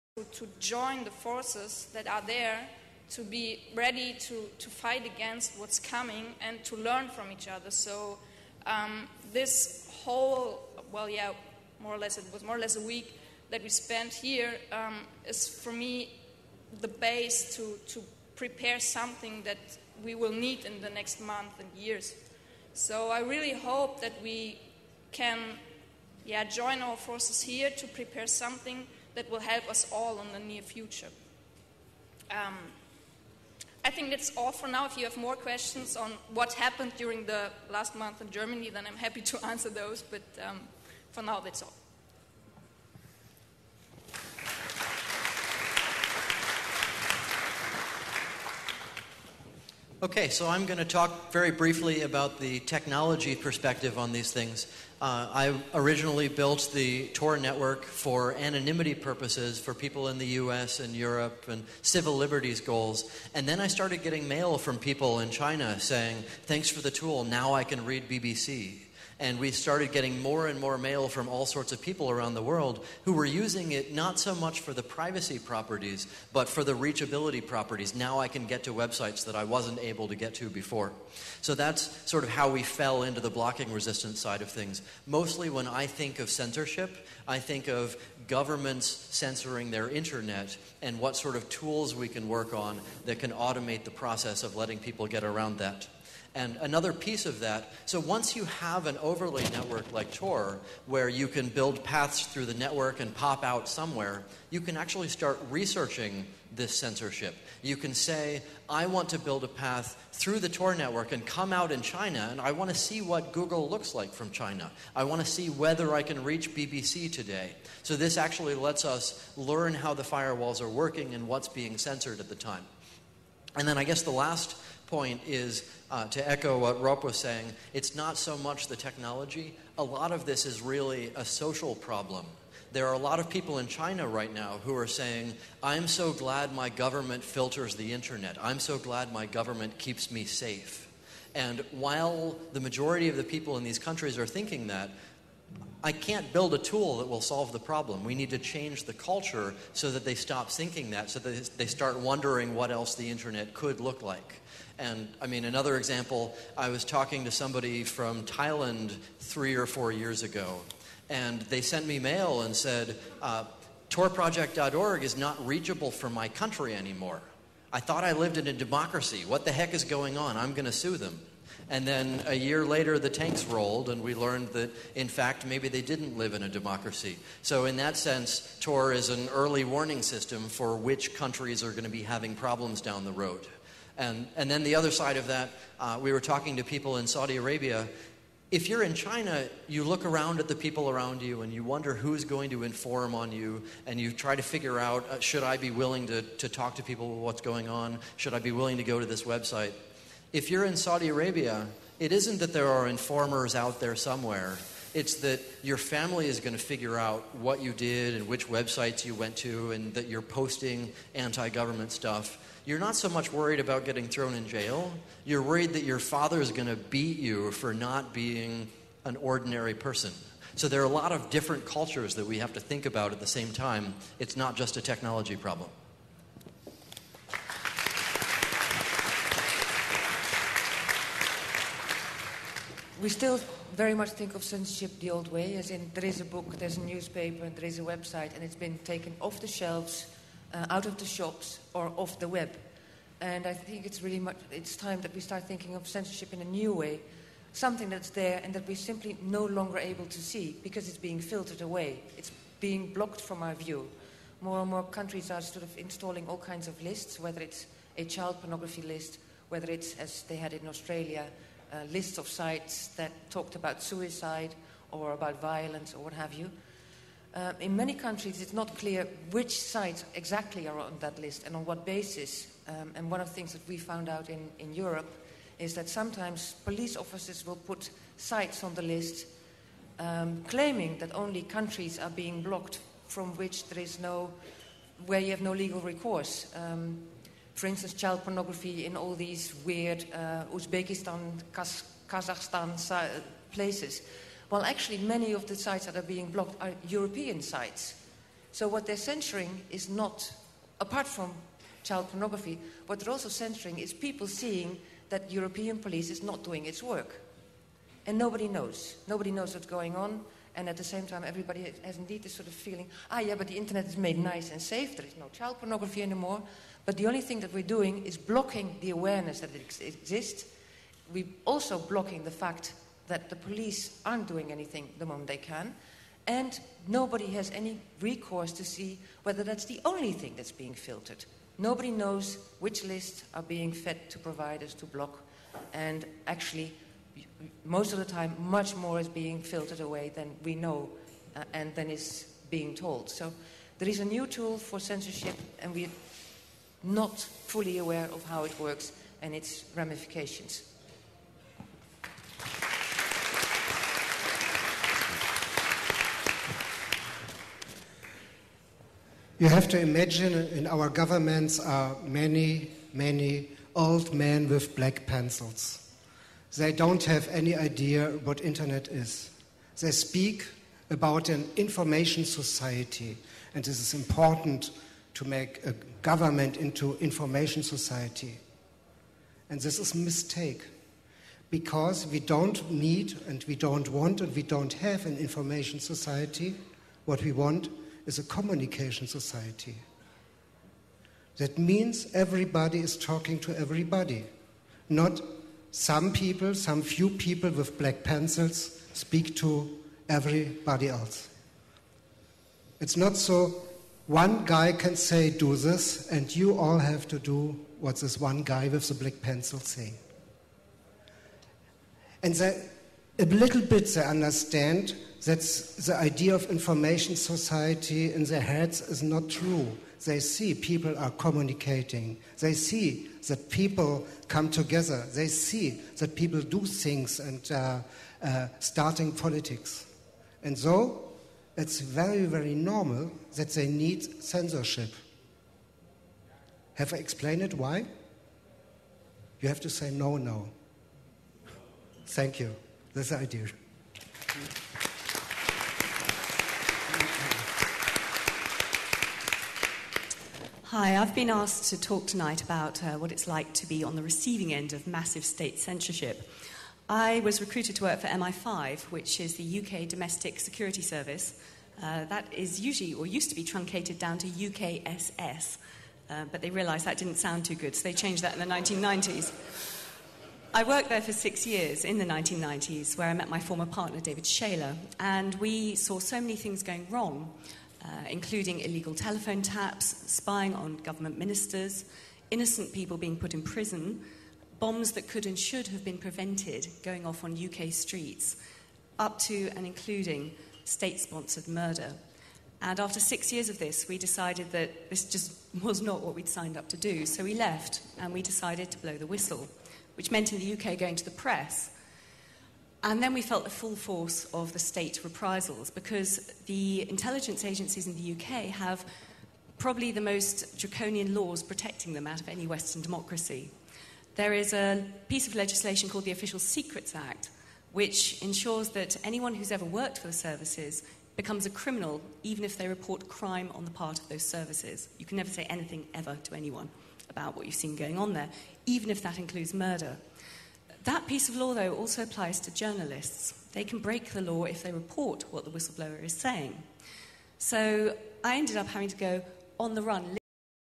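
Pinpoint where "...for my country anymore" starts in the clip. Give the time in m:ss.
2:45.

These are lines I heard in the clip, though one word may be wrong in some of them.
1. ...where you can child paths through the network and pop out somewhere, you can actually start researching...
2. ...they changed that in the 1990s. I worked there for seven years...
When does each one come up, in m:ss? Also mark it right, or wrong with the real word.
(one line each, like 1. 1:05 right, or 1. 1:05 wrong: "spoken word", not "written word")
1. 1:40 wrong: "build", not "child"
2. 7:47 wrong: "six", not "seven".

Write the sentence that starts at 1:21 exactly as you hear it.
So that's sort of how we fell into the blocking resistance side of things.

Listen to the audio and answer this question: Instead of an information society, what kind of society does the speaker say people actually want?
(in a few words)
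communication society.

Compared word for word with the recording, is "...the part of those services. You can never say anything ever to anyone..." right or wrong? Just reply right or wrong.
right.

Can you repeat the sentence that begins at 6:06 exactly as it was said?
They don't have any idea what internet is.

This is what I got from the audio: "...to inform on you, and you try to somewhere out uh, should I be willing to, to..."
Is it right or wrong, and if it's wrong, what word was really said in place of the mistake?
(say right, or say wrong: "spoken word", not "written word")
wrong: "figure", not "somewhere".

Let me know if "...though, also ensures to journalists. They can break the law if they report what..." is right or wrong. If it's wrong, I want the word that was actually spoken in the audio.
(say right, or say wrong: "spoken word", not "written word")
wrong: "applies", not "ensures".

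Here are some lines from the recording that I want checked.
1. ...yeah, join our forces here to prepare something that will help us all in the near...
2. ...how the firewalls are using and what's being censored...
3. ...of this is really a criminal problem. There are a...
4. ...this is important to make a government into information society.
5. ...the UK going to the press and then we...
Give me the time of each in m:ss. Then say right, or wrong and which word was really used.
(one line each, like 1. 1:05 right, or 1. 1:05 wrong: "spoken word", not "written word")
1. 0:26 right
2. 1:59 wrong: "working", not "using"
3. 2:10 wrong: "social", not "criminal"
4. 6:13 right
5. 8:20 right.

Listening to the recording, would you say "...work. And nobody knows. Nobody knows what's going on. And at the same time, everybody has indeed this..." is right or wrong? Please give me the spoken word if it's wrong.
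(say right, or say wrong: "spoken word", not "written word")
right.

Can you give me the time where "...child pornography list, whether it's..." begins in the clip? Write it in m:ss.
4:18.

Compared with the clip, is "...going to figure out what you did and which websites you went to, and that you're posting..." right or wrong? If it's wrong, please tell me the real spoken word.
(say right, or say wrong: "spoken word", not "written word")
right.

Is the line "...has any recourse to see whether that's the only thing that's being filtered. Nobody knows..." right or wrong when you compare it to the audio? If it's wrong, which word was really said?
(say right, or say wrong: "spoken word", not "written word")
right.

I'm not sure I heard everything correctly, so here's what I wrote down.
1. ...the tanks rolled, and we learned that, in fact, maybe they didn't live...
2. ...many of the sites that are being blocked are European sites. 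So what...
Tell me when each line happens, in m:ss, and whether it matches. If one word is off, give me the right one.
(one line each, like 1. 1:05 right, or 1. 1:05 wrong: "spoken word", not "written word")
1. 2:52 right
2. 4:54 right.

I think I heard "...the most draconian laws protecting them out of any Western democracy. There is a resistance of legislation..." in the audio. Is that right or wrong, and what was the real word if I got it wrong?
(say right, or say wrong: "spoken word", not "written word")
wrong: "piece", not "resistance".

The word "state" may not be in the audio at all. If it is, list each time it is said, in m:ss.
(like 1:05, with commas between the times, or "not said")
7:35, 8:10, 8:24.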